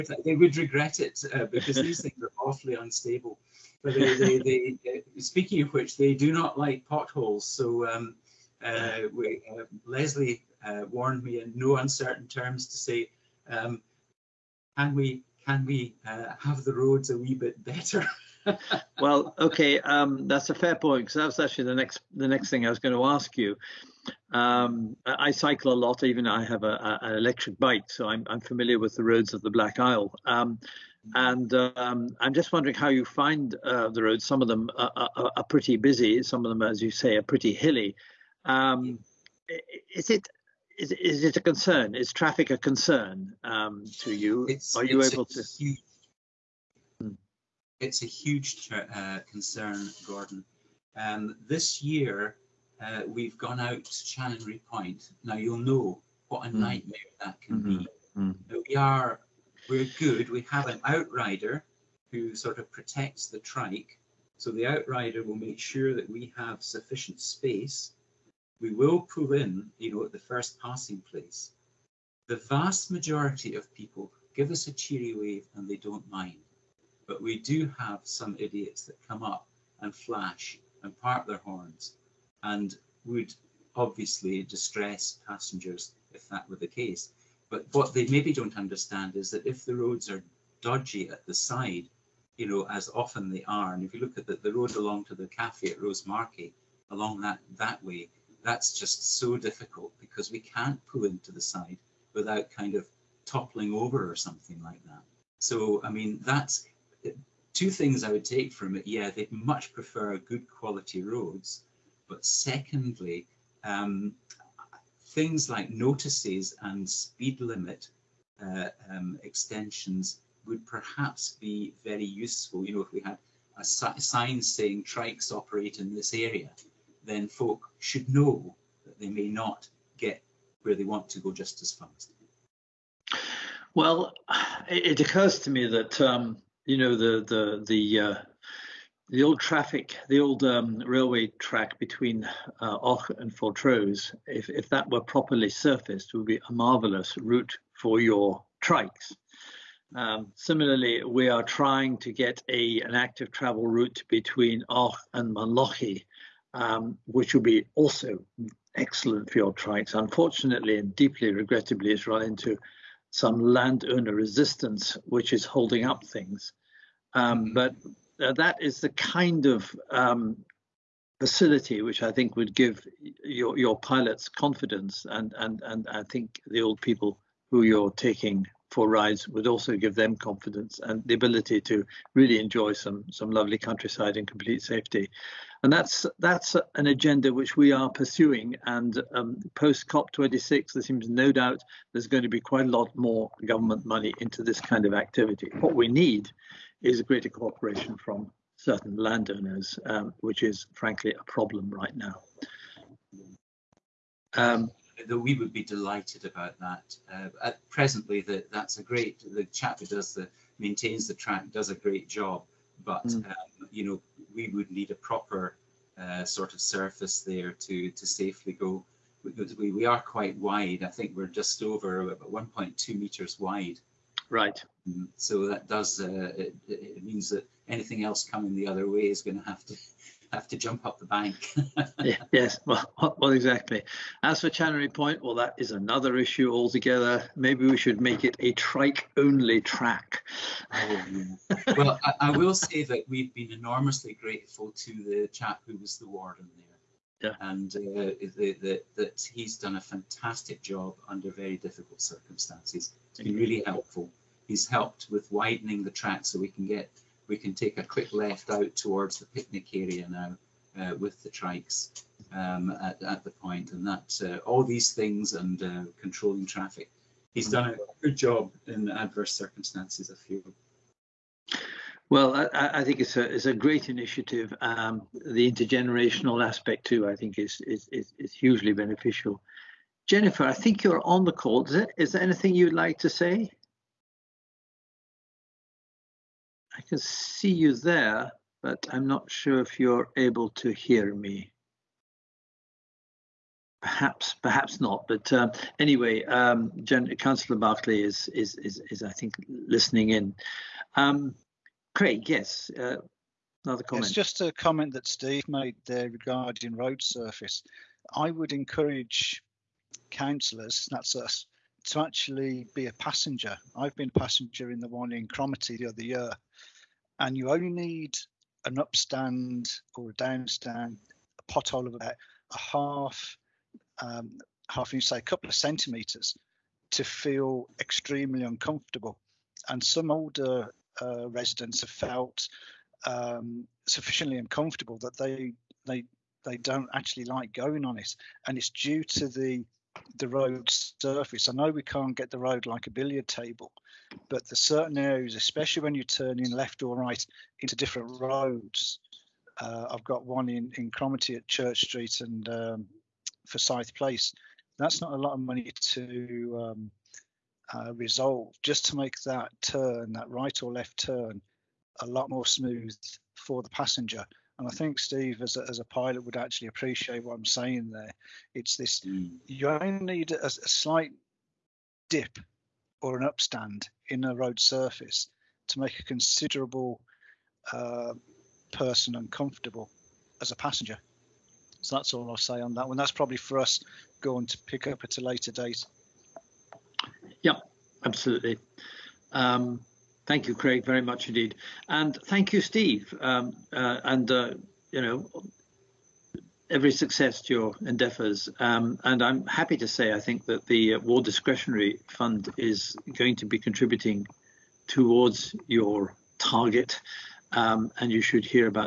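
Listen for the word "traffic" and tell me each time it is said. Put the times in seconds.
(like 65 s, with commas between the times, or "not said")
42 s, 139 s, 266 s.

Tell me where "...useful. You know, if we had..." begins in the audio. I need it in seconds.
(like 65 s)
122 s.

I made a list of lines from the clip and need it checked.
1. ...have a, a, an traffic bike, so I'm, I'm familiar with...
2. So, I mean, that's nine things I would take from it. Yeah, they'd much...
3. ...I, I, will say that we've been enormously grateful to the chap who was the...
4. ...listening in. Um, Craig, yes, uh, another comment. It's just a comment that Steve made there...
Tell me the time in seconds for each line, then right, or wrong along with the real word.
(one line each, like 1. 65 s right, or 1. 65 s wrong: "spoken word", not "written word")
1. 26 s wrong: "electric", not "traffic"
2. 105 s wrong: "two", not "nine"
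3. 242 s right
4. 299 s right.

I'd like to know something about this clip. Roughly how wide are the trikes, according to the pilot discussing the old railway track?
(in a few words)
1.2 meters.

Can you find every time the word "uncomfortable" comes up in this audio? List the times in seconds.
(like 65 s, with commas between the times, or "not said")
328 s, 334 s, 379 s.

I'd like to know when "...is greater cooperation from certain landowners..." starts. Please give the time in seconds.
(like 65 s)
196 s.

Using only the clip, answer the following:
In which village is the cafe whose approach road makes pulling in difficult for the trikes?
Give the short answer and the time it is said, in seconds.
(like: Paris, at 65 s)
Rosemarkie, at 95 s.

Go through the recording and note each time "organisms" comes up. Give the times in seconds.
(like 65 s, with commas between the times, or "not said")
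not said.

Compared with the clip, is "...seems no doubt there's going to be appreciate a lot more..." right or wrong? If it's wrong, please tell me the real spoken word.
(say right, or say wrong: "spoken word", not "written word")
wrong: "quite", not "appreciate".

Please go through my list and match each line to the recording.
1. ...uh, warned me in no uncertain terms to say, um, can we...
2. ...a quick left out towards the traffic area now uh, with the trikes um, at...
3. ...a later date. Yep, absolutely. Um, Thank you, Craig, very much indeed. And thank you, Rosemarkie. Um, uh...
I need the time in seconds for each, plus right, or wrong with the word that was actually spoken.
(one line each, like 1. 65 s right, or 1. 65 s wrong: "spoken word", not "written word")
1. 10 s right
2. 257 s wrong: "picnic", not "traffic"
3. 385 s wrong: "Steve", not "Rosemarkie".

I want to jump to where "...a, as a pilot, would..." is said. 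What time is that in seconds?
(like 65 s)
365 s.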